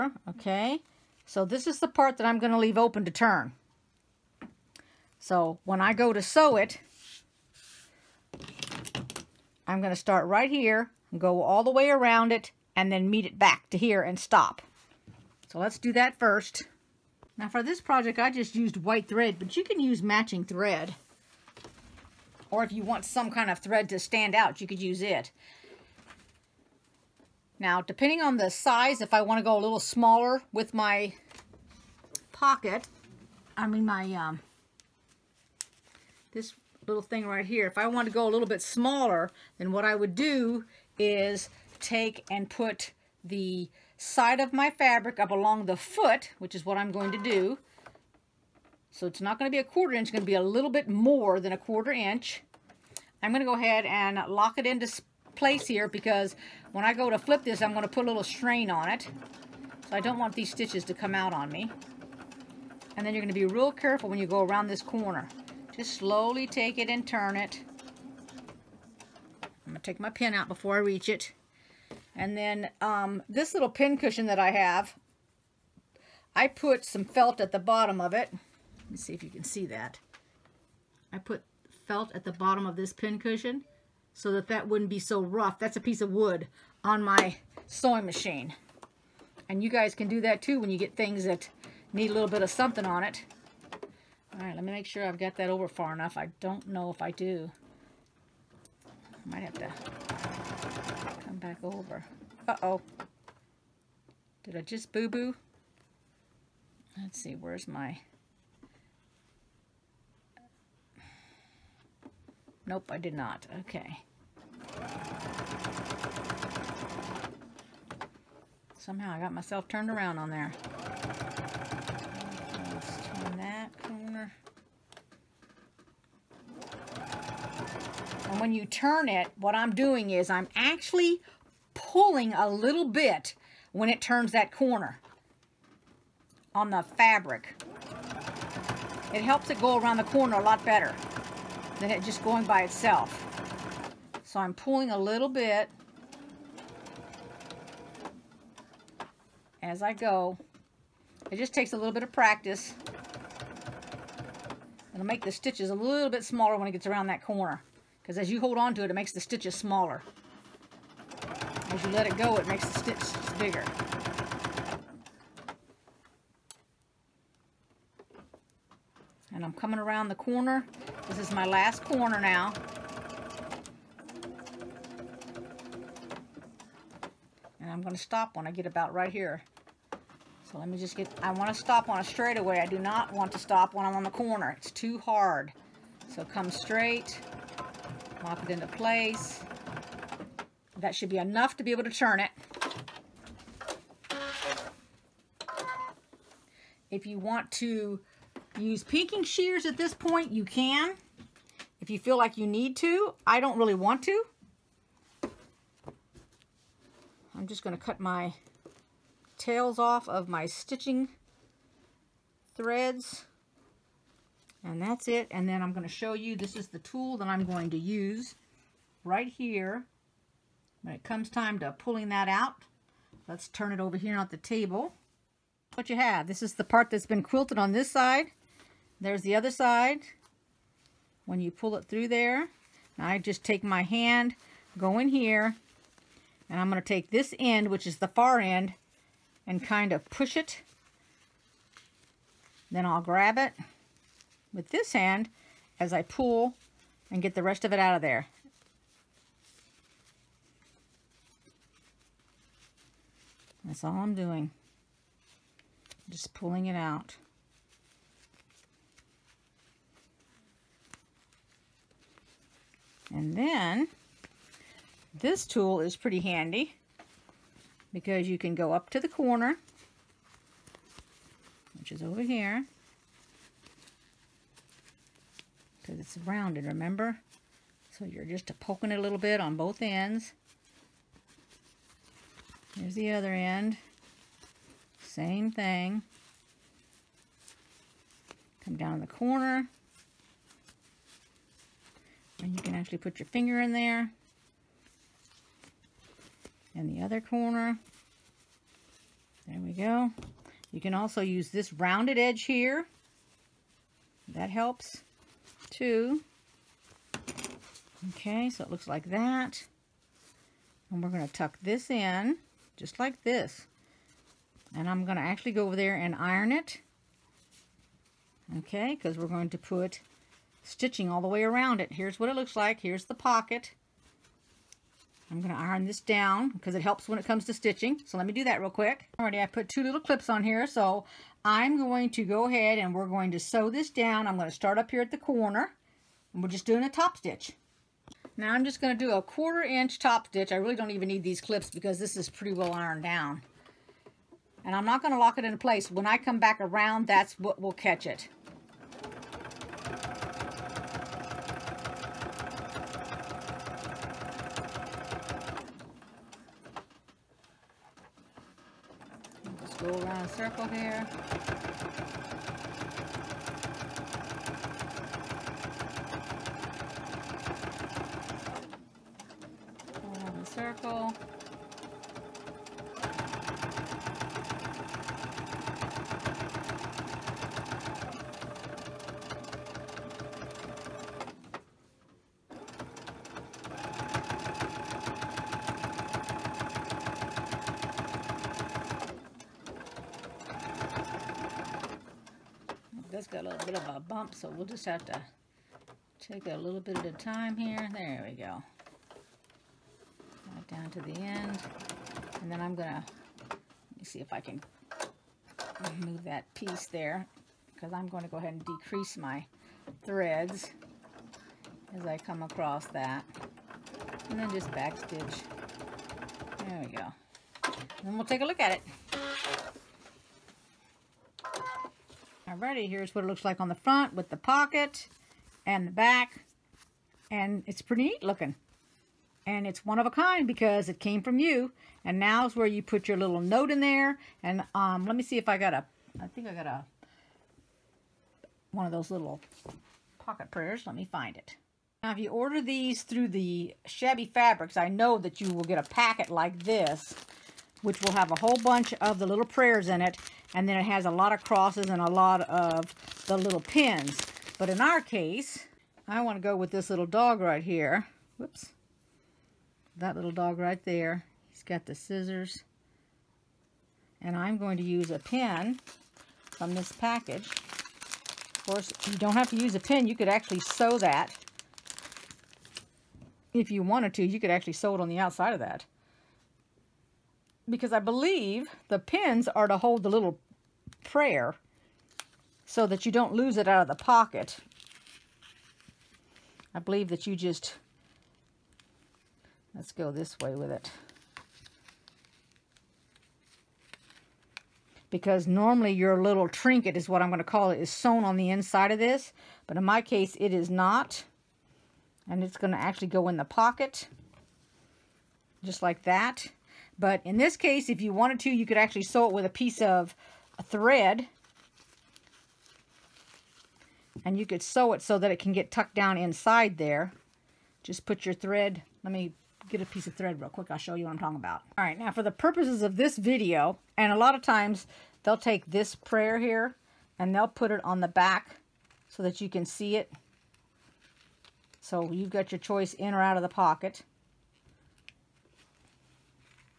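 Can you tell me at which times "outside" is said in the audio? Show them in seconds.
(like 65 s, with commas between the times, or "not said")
475 s.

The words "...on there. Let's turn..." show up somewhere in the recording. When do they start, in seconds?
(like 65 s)
120 s.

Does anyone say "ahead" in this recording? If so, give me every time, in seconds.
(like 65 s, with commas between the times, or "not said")
53 s, 332 s, 408 s.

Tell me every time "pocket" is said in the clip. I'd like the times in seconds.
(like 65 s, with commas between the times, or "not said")
32 s, 323 s, 424 s, 440 s, 484 s, 503 s, 533 s.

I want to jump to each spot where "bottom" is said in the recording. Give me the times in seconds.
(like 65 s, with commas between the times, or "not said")
77 s, 82 s.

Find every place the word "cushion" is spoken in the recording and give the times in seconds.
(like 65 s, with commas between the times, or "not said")
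73 s, 83 s.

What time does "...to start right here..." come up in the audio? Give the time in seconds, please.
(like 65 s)
9 s.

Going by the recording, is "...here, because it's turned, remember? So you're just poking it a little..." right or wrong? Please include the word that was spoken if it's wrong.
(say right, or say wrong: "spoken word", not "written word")
wrong: "rounded", not "turned".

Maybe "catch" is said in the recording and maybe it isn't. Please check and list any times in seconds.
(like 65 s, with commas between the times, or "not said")
347 s.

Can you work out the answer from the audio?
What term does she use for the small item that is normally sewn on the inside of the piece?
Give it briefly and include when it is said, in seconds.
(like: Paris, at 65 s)
Trinket, at 496 s.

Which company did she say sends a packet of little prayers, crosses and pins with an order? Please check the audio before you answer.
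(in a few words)
Shabby Fabrics.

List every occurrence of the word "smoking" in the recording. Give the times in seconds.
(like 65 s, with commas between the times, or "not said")
not said.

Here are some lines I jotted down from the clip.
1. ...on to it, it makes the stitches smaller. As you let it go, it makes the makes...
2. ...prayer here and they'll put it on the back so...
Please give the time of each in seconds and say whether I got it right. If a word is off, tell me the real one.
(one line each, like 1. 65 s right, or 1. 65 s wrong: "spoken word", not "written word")
1. 158 s wrong: "stitches", not "makes"
2. 525 s right.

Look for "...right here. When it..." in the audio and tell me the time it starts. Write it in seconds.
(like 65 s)
219 s.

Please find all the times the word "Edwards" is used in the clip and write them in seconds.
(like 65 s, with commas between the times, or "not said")
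not said.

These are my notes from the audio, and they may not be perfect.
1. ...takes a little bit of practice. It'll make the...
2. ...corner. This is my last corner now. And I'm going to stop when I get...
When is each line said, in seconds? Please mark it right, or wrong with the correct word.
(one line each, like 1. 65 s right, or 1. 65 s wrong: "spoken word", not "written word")
1. 151 s right
2. 170 s right.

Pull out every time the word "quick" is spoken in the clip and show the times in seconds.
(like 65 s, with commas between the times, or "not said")
328 s, 520 s.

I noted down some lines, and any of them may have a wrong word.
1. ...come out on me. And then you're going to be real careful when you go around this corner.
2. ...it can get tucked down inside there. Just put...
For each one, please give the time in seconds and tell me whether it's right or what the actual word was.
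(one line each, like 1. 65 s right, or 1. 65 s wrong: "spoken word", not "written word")
1. 60 s right
2. 515 s right.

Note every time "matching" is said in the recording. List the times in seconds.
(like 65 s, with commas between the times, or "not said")
20 s.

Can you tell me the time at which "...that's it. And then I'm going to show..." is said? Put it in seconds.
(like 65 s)
214 s.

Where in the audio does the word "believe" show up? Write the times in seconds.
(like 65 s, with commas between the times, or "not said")
477 s, 486 s.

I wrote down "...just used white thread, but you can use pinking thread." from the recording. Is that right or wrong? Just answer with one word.
wrong.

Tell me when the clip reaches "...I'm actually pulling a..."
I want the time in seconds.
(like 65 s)
130 s.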